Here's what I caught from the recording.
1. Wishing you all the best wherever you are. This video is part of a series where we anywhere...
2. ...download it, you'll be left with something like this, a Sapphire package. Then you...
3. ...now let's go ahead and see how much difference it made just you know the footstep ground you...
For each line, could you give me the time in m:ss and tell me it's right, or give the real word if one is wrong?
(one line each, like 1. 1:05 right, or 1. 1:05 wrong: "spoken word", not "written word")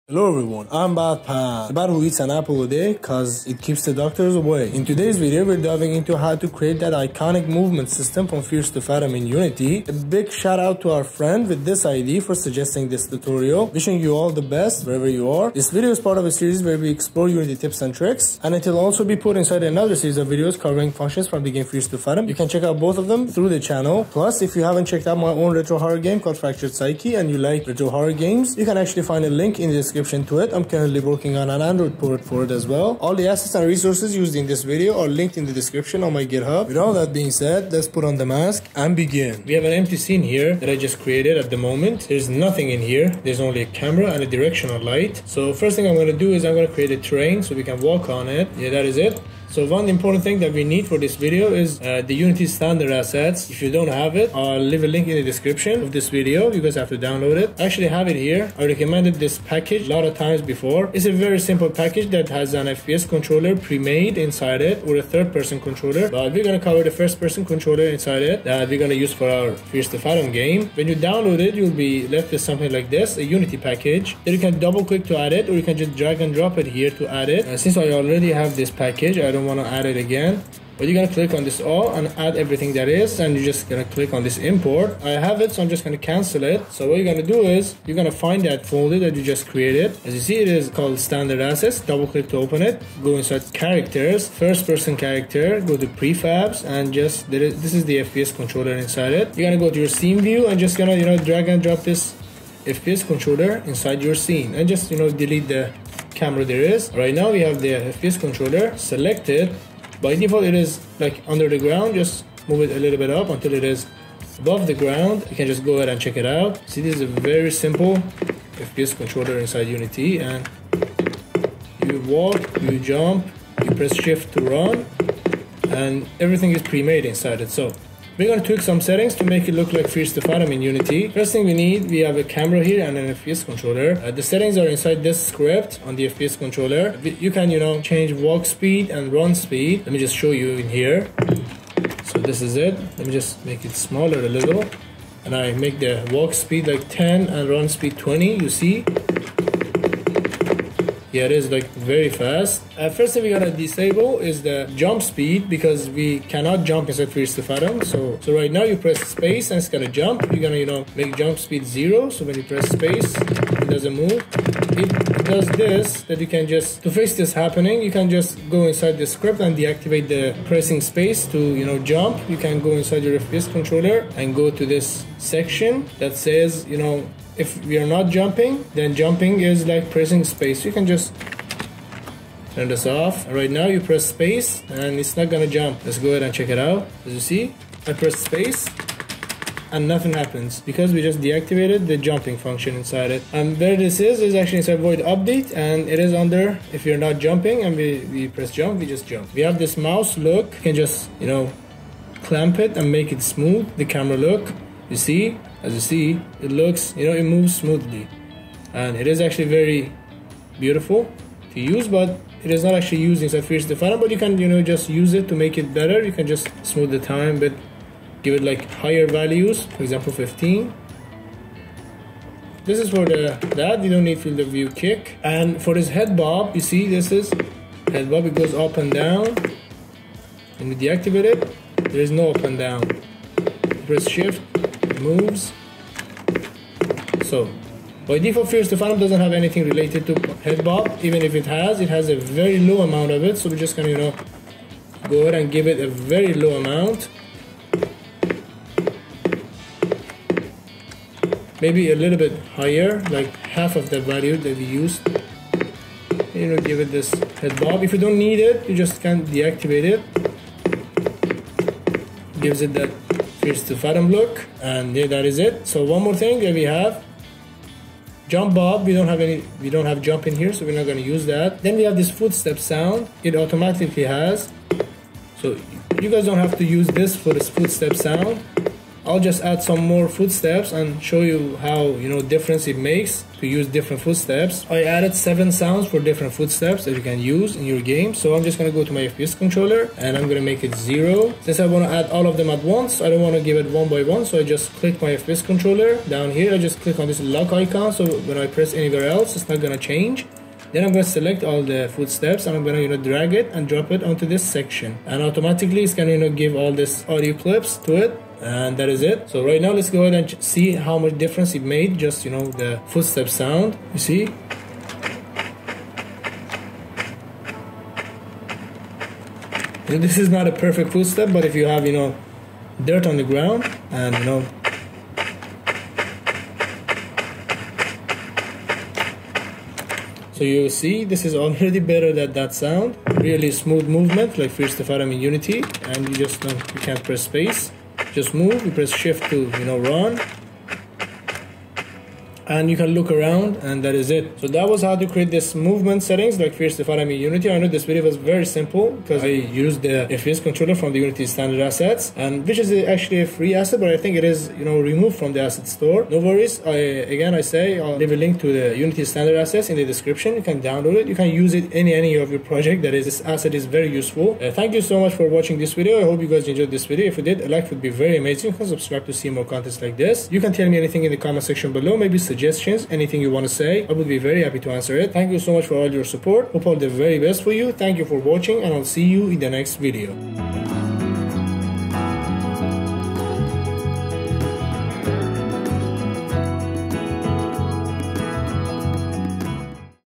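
1. 0:13 wrong: "explore", not "anywhere"
2. 1:10 wrong: "Unity", not "Sapphire"
3. 5:09 wrong: "sound", not "ground".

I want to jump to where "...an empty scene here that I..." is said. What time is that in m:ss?
0:39.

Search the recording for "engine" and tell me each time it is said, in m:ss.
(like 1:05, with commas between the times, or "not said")
not said.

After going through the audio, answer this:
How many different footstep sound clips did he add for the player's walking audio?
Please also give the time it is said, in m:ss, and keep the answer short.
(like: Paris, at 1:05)
7, at 4:45.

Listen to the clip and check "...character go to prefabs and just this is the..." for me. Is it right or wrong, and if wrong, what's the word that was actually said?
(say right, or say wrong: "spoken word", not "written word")
right.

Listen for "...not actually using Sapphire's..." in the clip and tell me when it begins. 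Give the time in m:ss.
3:32.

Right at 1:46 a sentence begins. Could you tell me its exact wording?
Right now we have the FPS controller selected.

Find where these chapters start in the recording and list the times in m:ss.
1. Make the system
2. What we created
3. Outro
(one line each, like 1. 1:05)
1. 0:39
2. 5:13
3. 5:44.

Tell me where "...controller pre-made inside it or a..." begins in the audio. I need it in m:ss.
1:03.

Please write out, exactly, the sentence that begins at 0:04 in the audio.
In today's video, we're diving into how to create that iconic movement system from Fears to Fathom in Unity.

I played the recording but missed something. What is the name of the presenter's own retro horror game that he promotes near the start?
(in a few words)
Fractured Psyche.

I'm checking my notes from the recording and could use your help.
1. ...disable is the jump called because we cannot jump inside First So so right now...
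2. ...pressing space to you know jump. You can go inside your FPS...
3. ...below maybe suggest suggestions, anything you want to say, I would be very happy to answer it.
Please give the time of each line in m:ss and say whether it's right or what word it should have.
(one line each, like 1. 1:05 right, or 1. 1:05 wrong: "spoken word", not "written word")
1. 2:33 wrong: "speed", not "called"
2. 2:50 right
3. 6:11 right.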